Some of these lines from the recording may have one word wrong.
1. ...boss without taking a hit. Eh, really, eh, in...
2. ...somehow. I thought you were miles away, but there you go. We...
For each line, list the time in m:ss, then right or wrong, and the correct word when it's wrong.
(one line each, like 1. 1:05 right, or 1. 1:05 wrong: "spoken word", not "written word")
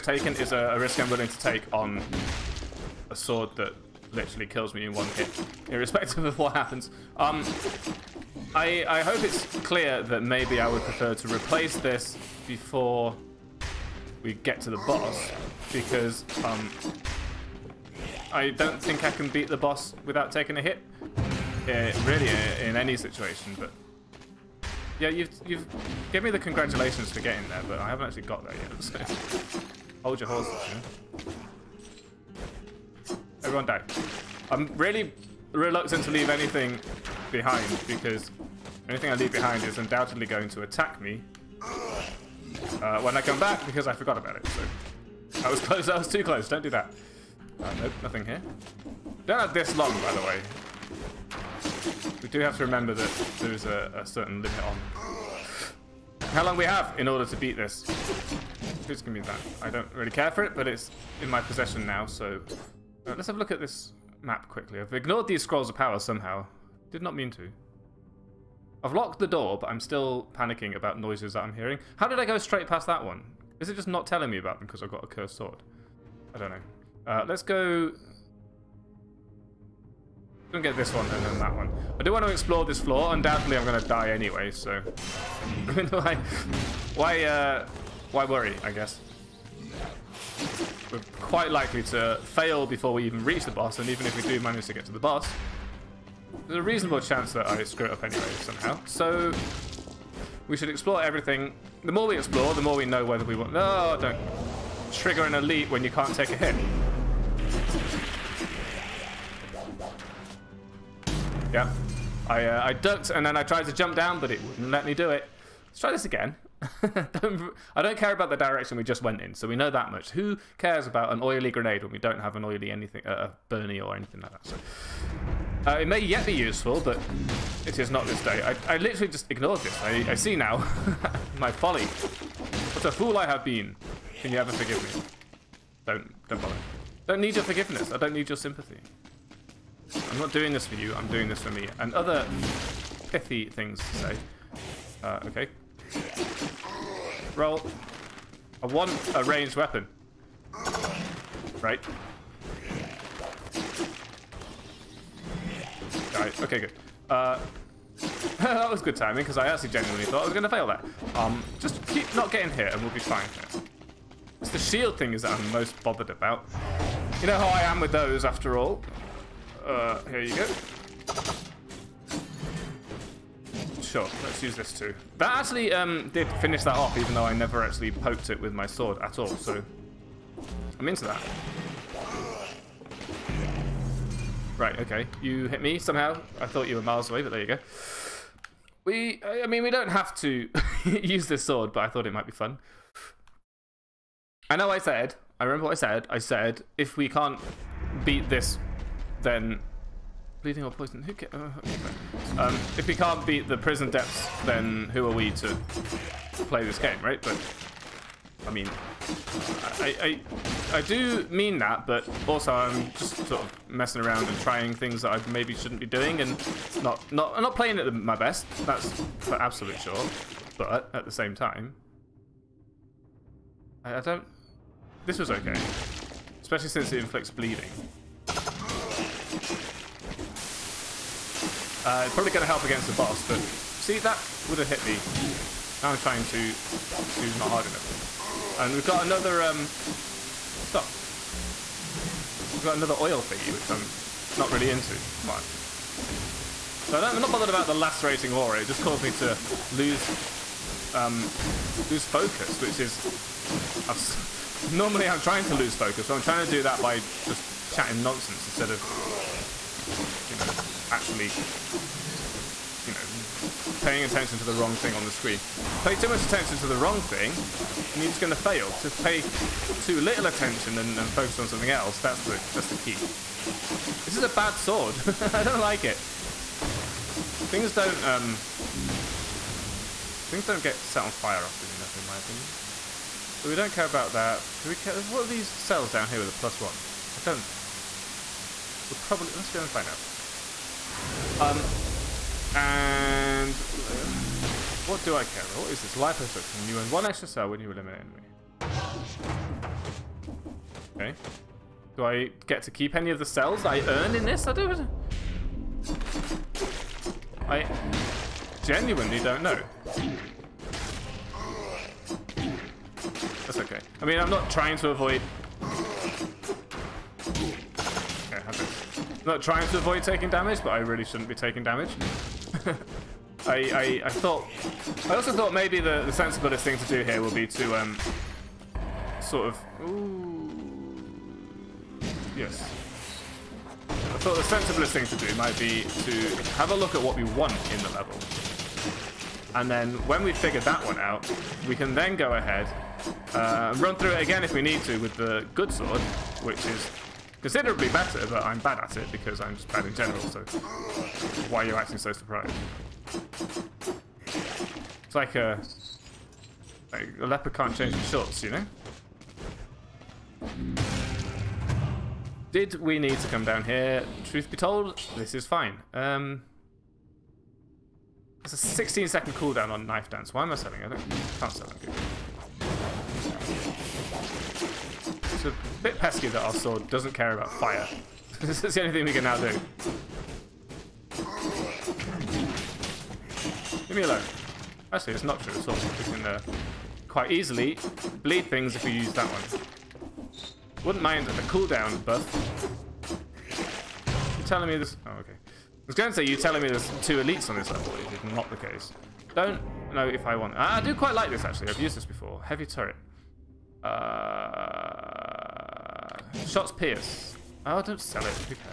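1. 0:19 right
2. 3:05 right.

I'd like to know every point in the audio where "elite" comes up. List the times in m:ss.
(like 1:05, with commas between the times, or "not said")
1:45, 6:37.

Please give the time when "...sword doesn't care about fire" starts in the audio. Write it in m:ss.
6:16.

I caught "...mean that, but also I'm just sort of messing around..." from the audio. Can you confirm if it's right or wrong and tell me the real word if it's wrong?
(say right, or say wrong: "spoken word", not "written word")
right.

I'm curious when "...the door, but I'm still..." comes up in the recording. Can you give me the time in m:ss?
1:09.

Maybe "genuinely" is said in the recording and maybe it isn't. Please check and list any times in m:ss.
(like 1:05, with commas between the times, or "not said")
2:39, 5:08.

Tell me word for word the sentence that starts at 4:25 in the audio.
Pay too much attention to the wrong thing, and you're just going to fail.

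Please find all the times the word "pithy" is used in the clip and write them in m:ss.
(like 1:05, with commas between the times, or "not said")
2:23.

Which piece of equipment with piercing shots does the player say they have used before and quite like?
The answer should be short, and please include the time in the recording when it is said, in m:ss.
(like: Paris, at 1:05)
Heavy turret, at 6:42.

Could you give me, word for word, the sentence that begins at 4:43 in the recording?
So we don't care about that.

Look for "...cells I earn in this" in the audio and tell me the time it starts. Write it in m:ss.
5:03.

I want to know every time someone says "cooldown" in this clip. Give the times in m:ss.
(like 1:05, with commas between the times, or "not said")
6:09, 6:31.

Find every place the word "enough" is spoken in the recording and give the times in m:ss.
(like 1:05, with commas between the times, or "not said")
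3:57, 4:41.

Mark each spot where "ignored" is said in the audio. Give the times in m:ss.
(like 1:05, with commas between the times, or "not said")
1:04, 2:09.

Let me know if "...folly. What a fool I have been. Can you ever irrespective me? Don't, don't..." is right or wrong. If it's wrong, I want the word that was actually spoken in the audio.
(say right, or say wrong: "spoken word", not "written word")
wrong: "forgive", not "irrespective".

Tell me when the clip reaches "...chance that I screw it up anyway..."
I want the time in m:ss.
1:37.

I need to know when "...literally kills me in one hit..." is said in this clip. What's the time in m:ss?
0:04.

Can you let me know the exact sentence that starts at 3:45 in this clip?
This was okay, especially since it inflicts bleeding.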